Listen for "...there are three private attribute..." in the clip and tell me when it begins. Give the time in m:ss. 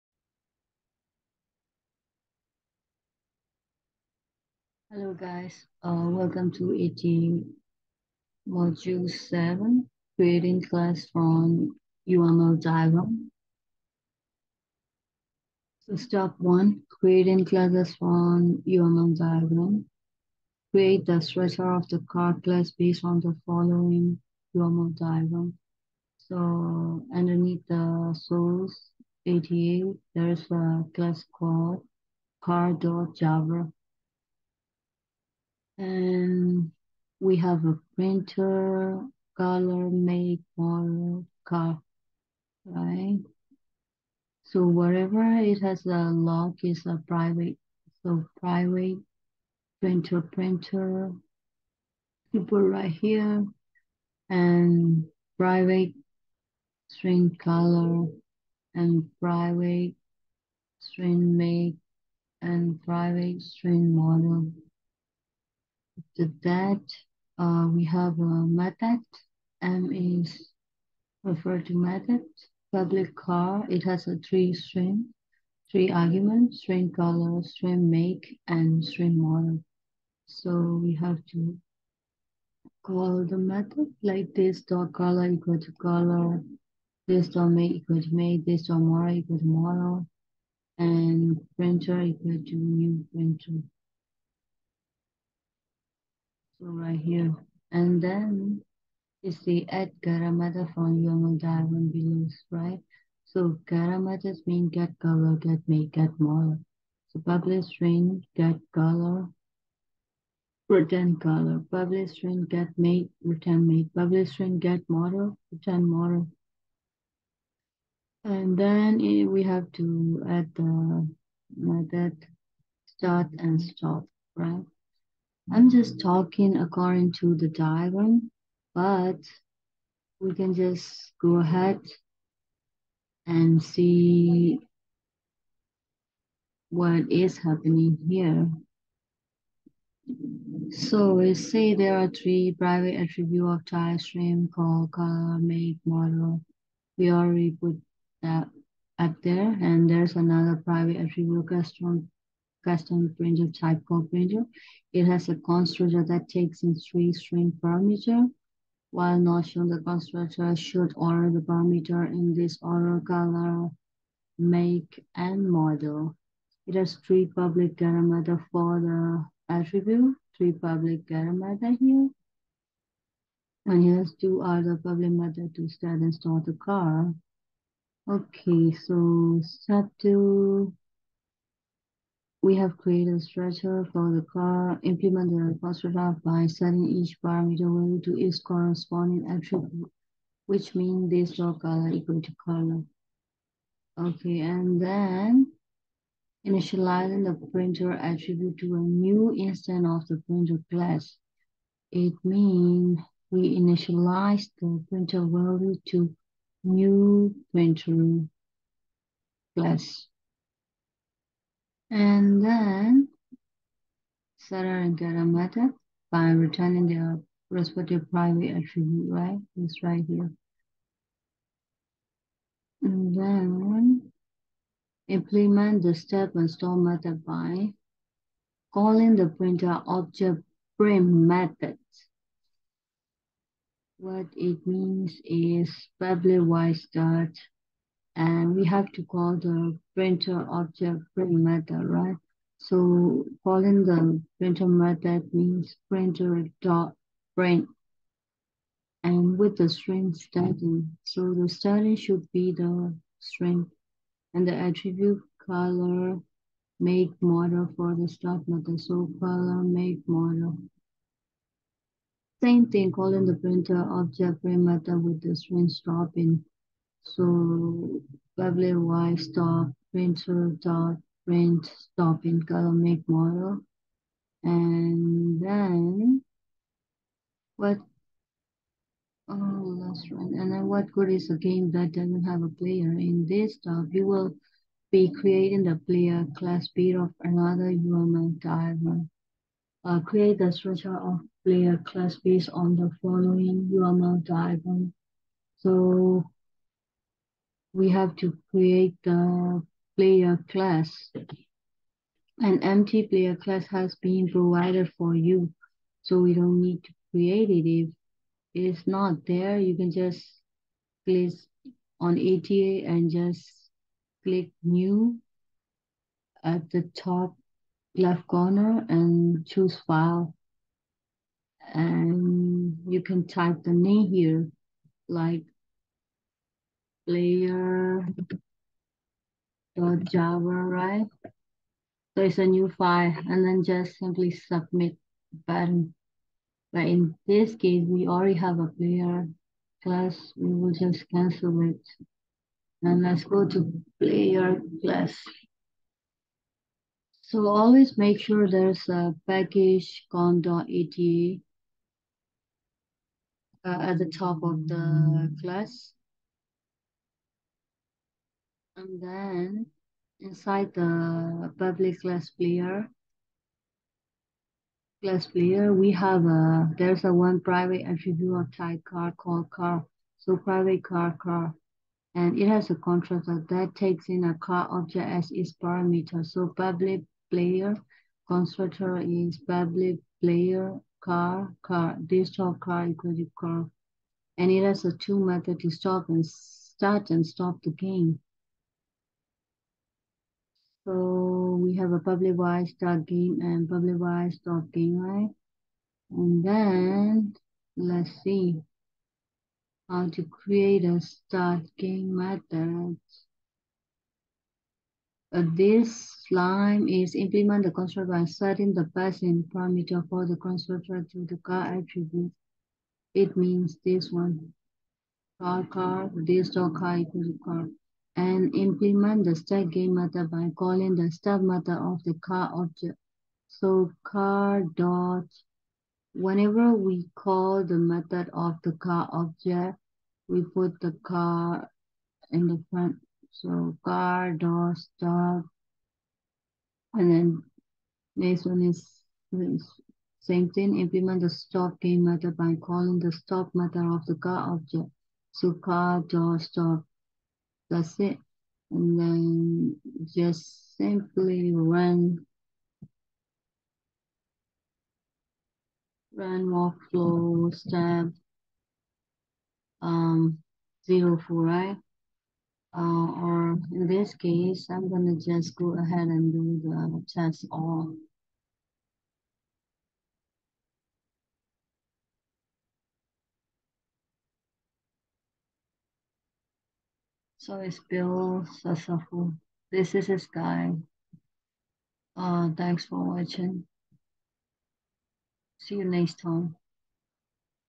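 2:21.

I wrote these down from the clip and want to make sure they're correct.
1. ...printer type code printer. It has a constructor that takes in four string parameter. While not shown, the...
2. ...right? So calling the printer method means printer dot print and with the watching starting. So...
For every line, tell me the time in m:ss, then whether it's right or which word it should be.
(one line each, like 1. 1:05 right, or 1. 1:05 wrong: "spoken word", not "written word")
1. 2:33 wrong: "three", not "four"
2. 4:01 wrong: "string", not "watching".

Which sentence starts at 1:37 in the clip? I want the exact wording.
And then you see add Garamata from your diamond below, right?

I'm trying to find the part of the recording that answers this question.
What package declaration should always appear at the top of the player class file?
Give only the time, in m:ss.
5:50.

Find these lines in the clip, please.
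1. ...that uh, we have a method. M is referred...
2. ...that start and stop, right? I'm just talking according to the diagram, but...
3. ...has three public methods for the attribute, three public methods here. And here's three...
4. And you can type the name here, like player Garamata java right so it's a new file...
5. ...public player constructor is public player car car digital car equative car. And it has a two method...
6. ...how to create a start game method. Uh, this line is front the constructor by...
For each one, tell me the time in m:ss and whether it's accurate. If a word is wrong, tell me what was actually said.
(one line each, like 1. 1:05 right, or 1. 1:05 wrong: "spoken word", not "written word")
1. 1:06 right
2. 2:01 right
3. 2:46 wrong: "two", not "three"
4. 5:21 wrong: "Dot", not "Garamata"
5. 6:16 right
6. 6:39 wrong: "implement", not "front".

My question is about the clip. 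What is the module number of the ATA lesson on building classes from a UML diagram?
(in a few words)
7.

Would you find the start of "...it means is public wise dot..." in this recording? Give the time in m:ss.
3:54.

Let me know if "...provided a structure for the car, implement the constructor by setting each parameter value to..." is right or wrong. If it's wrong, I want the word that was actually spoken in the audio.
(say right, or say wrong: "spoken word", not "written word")
wrong: "created", not "provided".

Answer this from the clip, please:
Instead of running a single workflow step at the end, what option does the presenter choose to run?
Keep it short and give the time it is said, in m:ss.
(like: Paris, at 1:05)
test all, at 7:47.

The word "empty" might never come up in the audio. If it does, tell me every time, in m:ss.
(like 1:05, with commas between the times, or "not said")
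5:02.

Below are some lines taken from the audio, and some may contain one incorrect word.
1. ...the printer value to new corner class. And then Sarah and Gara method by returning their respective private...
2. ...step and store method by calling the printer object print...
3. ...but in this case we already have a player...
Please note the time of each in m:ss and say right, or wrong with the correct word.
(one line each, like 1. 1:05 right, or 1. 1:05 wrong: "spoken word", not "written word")
1. 3:24 wrong: "printer", not "corner"
2. 3:45 right
3. 5:36 right.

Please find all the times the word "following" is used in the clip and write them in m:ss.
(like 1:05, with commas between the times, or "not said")
0:23, 4:53.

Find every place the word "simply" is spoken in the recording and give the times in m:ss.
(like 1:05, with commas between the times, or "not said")
5:33, 7:30.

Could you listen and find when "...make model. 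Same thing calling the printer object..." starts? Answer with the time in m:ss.
4:19.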